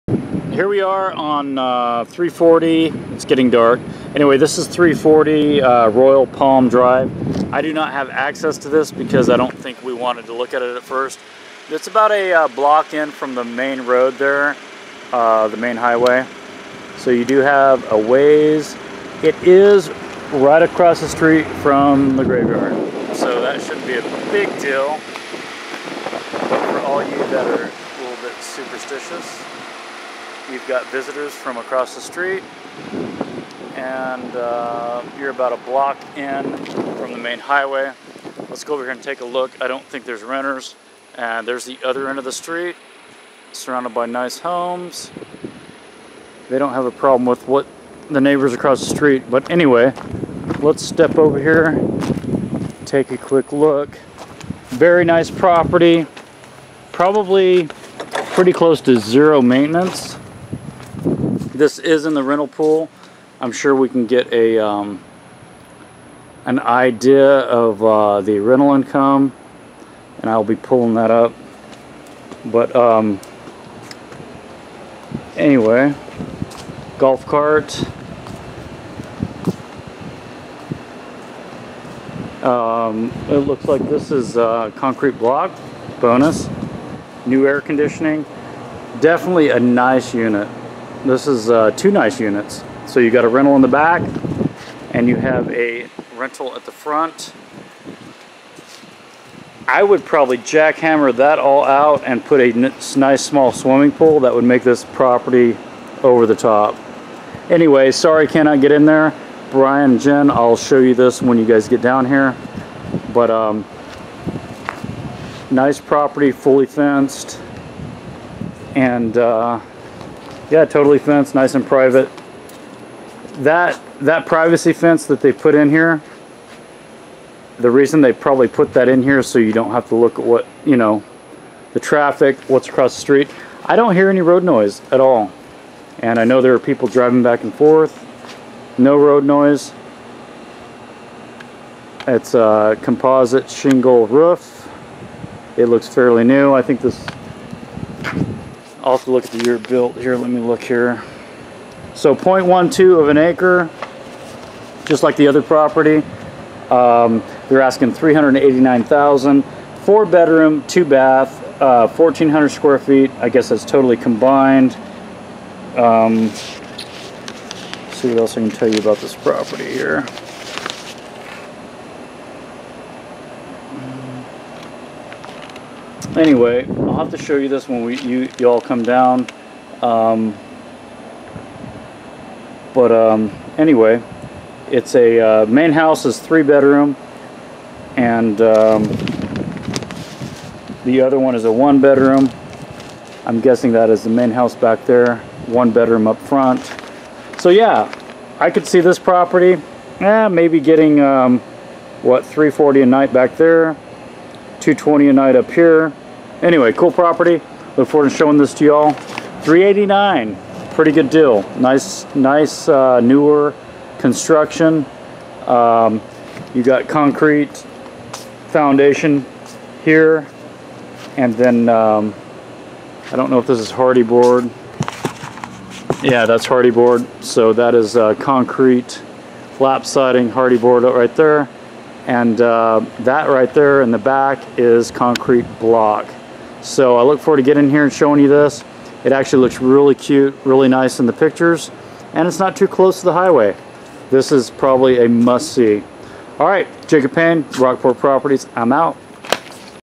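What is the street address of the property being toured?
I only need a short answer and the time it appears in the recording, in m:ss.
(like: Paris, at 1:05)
340 Royal Palm Drive, at 0:04.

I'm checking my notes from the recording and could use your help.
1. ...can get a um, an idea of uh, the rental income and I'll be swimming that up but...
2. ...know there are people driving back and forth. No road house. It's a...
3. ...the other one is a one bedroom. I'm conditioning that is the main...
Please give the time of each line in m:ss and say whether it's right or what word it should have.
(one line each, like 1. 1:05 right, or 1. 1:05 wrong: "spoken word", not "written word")
1. 1:03 wrong: "pulling", not "swimming"
2. 2:16 wrong: "noise", not "house"
3. 3:10 wrong: "guessing", not "conditioning".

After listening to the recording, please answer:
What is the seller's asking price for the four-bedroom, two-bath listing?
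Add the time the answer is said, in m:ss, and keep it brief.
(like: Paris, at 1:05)
389,000, at 2:37.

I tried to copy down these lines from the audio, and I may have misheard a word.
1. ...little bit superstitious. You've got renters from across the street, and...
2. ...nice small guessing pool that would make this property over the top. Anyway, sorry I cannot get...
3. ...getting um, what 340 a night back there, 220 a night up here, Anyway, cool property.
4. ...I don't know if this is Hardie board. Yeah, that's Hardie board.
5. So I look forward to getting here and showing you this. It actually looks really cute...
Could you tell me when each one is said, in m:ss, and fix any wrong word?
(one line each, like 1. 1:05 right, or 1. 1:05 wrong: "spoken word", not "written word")
1. 0:28 wrong: "visitors", not "renters"
2. 1:42 wrong: "swimming", not "guessing"
3. 3:20 right
4. 3:43 right
5. 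3:56 right.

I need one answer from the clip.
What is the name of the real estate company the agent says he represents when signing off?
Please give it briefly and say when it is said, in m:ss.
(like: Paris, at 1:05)
Rockport Properties, at 4:07.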